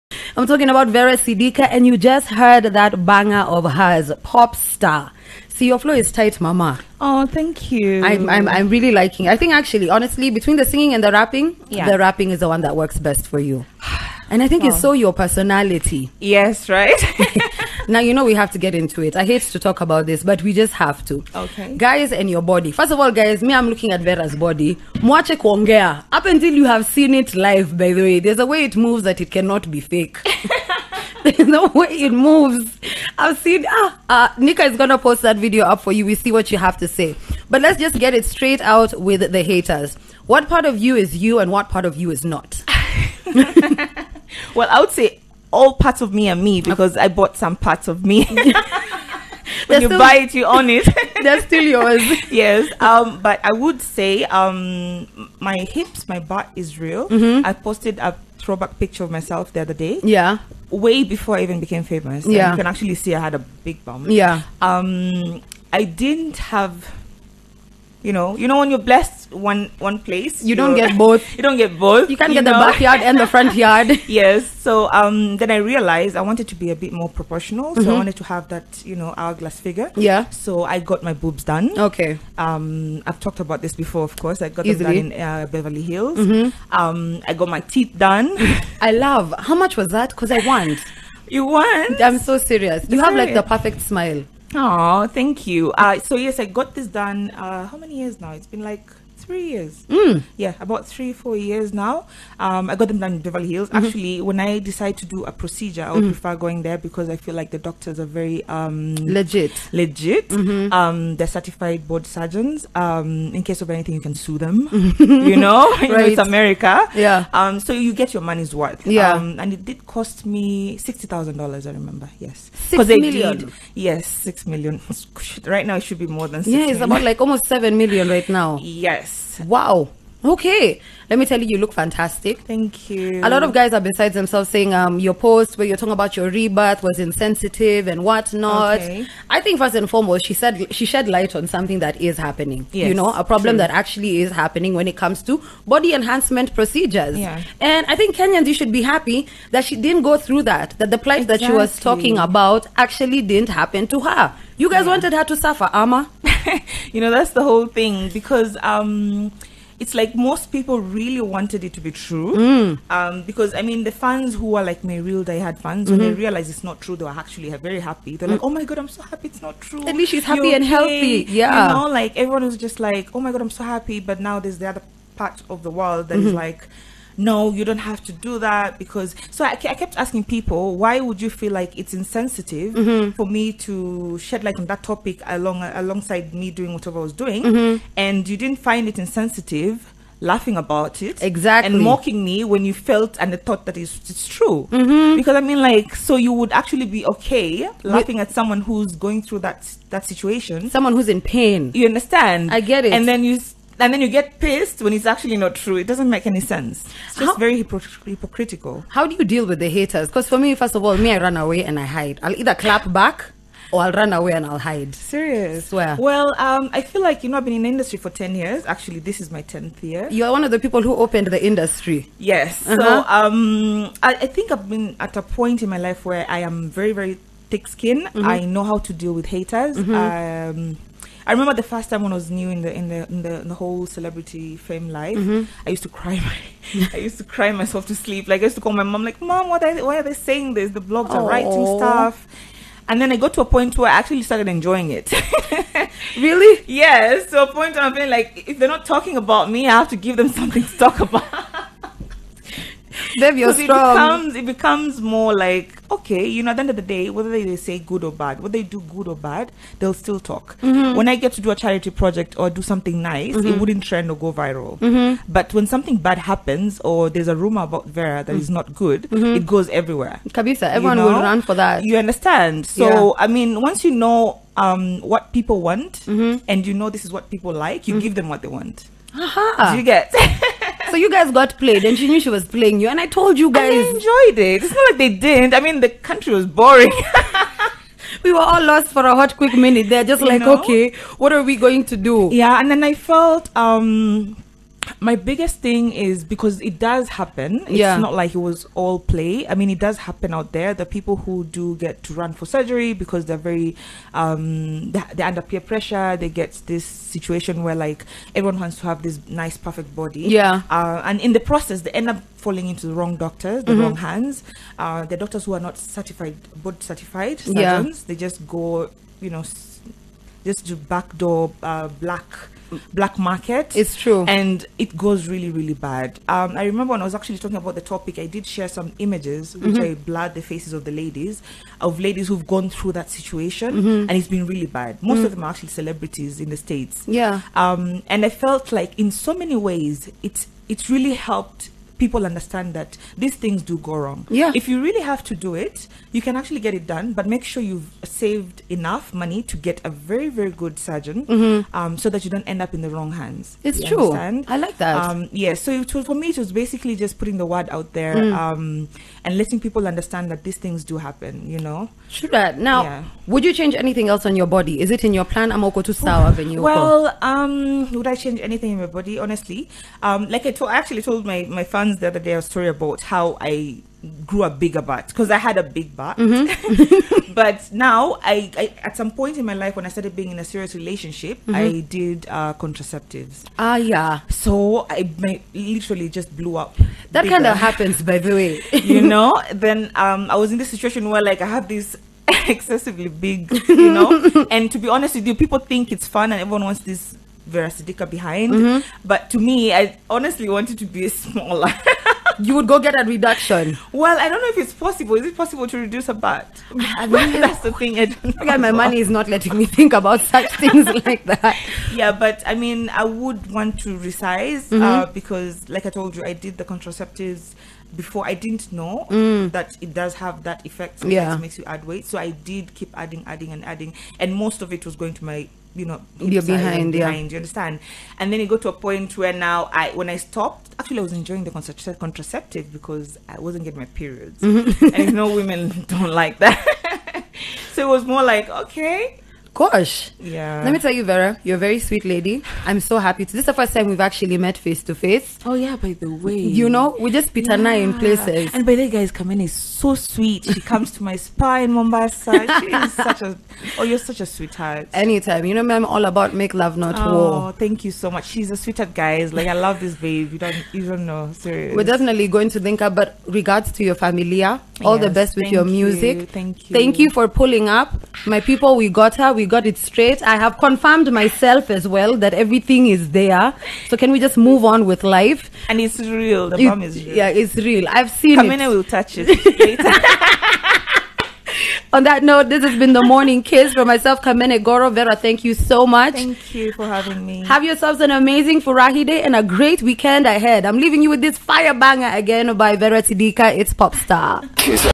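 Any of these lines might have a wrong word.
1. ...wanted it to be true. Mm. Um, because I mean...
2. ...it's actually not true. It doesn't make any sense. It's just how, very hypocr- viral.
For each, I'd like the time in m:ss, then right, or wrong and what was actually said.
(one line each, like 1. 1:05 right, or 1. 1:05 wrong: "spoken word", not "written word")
1. 2:41 right
2. 3:24 wrong: "hypocritical", not "viral".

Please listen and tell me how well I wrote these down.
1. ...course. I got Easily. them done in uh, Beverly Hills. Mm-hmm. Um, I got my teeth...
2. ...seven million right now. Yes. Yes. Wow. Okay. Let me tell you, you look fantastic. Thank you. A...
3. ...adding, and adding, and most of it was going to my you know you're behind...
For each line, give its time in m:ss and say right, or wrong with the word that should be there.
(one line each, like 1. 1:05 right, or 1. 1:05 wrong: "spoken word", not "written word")
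1. 1:24 right
2. 2:07 right
3. 7:03 right.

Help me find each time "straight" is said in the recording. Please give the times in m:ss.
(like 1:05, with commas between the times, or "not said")
0:38, 7:49.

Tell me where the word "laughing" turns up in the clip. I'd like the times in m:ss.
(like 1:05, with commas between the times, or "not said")
3:10, 3:17.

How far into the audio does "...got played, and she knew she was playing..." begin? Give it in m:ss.
4:41.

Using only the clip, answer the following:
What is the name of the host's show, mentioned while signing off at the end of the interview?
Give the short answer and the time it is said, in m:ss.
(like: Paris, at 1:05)
The Morning Kiss, at 8:02.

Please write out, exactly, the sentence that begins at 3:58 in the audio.
Like I used to call my mom, like, "Mom, what are why are they saying this?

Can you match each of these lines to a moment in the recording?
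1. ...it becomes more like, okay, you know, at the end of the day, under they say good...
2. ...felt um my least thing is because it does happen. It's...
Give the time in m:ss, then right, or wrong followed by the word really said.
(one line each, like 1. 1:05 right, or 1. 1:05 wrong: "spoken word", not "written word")
1. 4:14 wrong: "whether", not "under"
2. 4:52 wrong: "biggest", not "least".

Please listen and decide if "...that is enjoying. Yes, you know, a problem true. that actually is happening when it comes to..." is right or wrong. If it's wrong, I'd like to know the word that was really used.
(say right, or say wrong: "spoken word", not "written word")
wrong: "happening", not "enjoying".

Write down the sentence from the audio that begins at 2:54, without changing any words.
But now there's the other part of the world that mm-hmm.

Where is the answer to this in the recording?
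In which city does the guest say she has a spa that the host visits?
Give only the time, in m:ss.
7:31.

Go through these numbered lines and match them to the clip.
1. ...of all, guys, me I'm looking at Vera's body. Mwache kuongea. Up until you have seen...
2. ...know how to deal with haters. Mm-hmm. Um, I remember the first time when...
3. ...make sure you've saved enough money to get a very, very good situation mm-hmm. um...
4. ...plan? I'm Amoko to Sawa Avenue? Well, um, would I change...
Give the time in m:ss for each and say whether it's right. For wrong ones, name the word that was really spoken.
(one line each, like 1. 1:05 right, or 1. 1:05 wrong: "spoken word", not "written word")
1. 0:22 right
2. 3:48 right
3. 5:47 wrong: "surgeon", not "situation"
4. 6:05 right.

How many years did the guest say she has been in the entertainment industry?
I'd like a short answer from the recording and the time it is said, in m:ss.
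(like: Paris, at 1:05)
10 years, at 3:38.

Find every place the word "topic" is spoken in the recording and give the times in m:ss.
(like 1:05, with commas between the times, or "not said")
3:04, 5:27.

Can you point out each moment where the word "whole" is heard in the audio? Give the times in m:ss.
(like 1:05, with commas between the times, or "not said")
2:37, 3:53.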